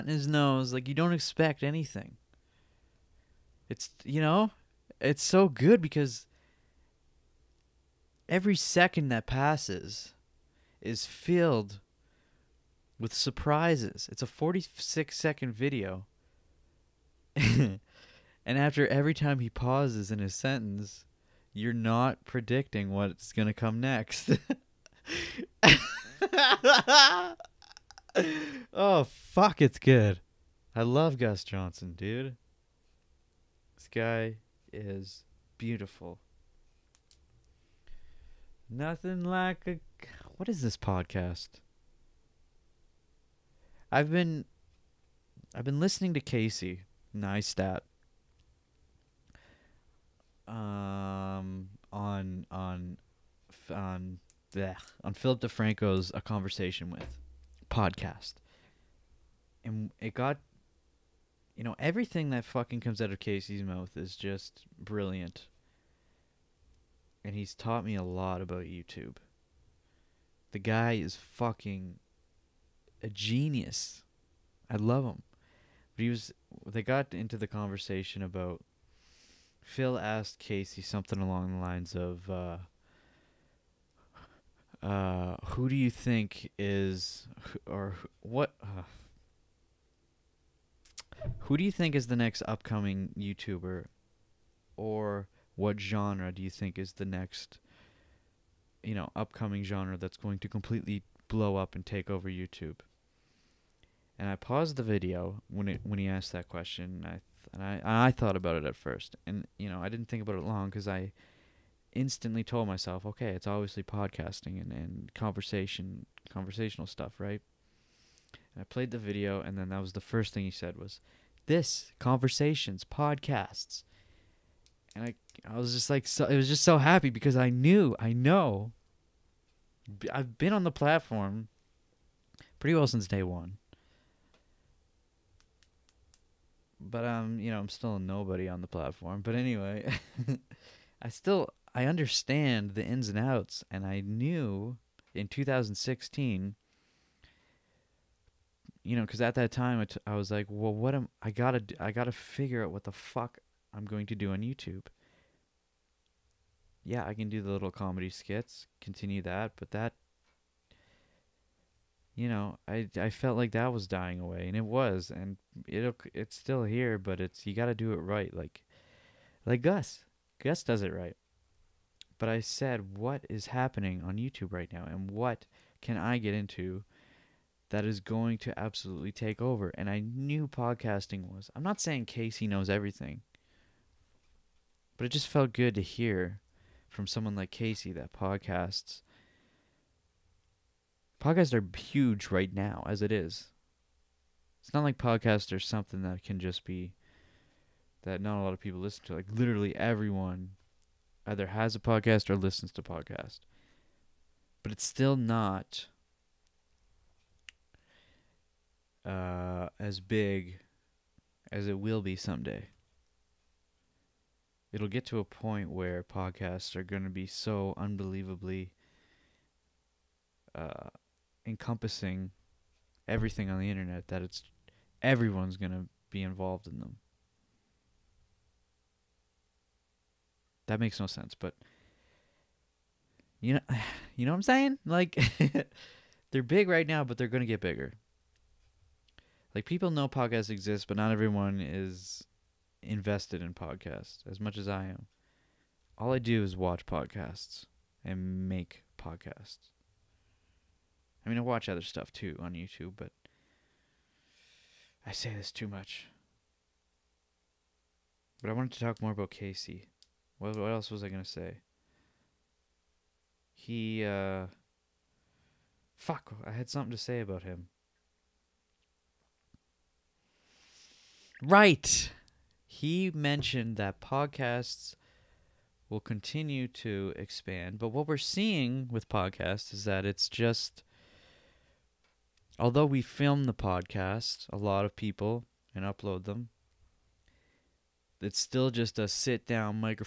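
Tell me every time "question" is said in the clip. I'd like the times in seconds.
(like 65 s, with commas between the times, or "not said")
106 s.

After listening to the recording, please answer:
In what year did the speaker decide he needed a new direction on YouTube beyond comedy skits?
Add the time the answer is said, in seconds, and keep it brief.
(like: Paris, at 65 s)
2016, at 145 s.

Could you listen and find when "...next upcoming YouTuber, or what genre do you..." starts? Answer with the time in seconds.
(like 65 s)
92 s.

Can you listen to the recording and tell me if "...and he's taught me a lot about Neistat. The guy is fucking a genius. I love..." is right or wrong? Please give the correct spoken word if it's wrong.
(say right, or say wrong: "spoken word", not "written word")
wrong: "YouTube", not "Neistat".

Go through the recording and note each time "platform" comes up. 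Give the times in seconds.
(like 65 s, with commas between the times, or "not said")
130 s, 138 s.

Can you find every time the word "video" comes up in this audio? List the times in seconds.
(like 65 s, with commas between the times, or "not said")
15 s, 104 s, 118 s.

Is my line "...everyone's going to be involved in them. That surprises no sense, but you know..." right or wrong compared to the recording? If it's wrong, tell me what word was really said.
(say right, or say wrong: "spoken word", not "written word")
wrong: "makes", not "surprises".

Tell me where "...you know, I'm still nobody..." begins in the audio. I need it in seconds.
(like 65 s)
137 s.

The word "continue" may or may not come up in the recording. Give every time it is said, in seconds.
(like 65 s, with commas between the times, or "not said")
158 s, 275 s.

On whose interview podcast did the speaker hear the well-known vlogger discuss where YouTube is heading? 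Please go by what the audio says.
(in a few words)
Philip DeFranco.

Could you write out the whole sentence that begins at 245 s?
All I do is watch podcasts and make podcasts.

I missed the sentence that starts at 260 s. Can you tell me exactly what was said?
What, what else was I going to say?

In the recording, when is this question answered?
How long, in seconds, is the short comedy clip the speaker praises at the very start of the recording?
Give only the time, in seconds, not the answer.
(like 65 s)
14 s.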